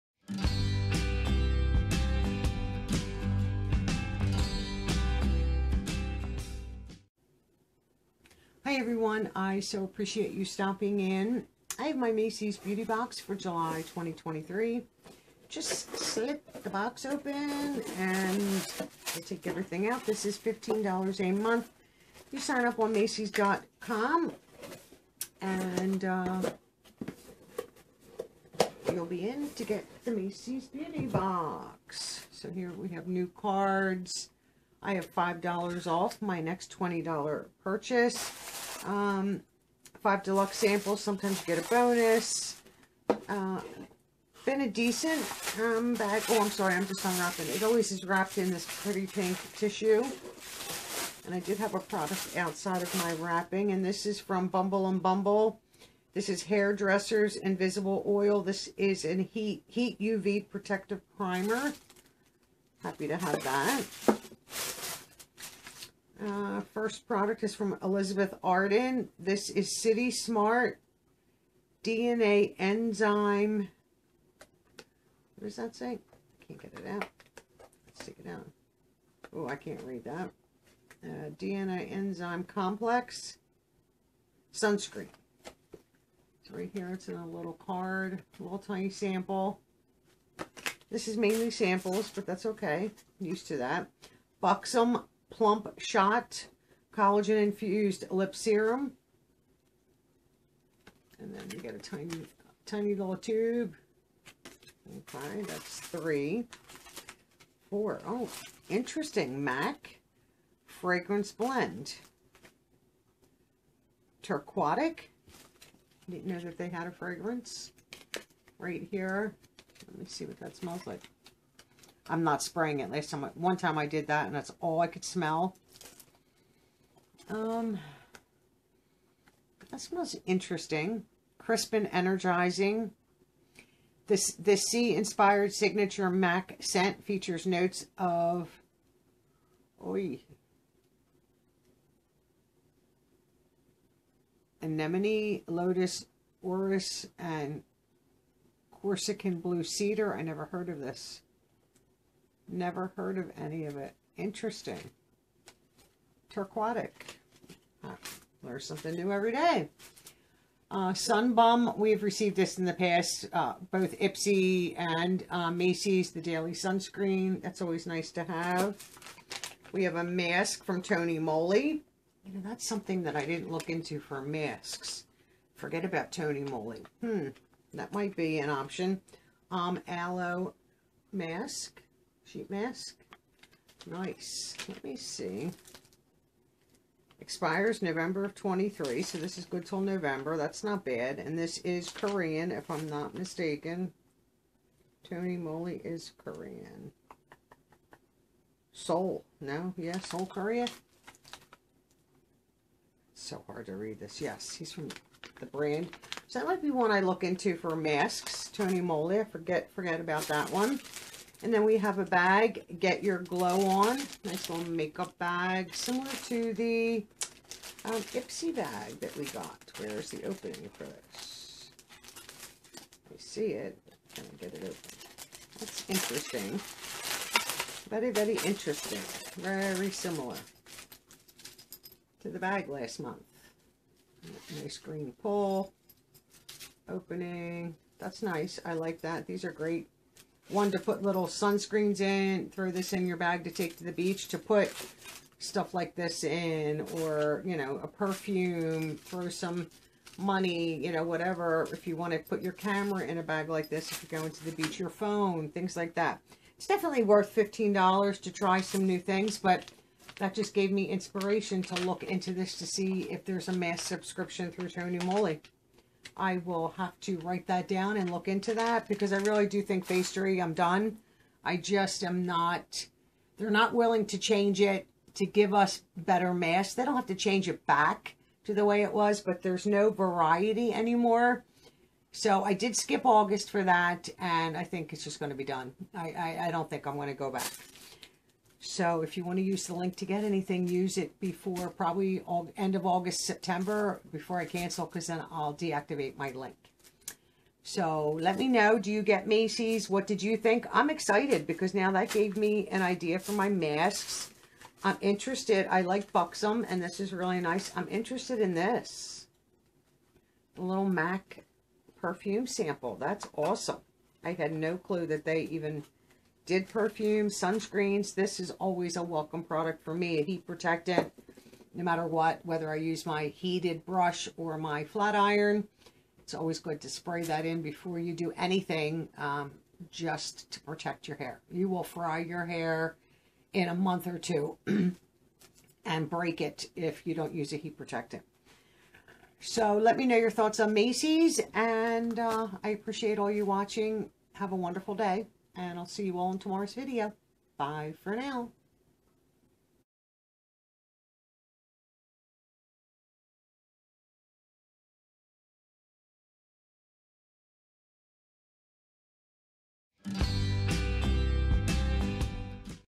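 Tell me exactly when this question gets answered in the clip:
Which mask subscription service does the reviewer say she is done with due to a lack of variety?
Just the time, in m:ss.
4:29.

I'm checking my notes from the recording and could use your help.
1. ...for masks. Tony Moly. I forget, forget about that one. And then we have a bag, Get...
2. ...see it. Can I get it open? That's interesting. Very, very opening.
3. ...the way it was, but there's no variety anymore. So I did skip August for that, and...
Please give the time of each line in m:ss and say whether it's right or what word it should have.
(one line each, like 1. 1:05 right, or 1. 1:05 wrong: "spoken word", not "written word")
1. 3:27 right
2. 3:43 wrong: "interesting", not "opening"
3. 4:38 right.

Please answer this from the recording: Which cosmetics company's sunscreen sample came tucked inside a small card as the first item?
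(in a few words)
Elizabeth Arden.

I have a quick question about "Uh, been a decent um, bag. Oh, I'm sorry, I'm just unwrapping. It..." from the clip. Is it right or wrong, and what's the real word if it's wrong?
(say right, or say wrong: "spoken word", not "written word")
right.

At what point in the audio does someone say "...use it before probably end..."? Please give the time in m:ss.
4:50.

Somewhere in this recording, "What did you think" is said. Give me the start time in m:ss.
4:59.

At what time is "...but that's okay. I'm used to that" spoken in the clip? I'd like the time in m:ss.
1:32.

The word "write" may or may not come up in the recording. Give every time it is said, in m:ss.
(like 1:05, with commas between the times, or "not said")
4:27.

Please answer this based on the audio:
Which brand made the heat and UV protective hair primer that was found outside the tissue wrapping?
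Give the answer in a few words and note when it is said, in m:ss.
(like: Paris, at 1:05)
Bumble and Bumble, at 0:54.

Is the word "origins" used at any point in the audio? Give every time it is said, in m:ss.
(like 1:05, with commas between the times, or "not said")
not said.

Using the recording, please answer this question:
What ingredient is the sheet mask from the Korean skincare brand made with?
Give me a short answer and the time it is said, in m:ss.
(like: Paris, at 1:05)
aloe, at 2:59.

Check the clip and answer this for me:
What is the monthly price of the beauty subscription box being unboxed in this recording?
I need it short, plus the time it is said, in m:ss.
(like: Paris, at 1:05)
$15, at 0:20.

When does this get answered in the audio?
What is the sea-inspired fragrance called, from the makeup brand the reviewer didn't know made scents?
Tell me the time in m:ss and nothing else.
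1:54.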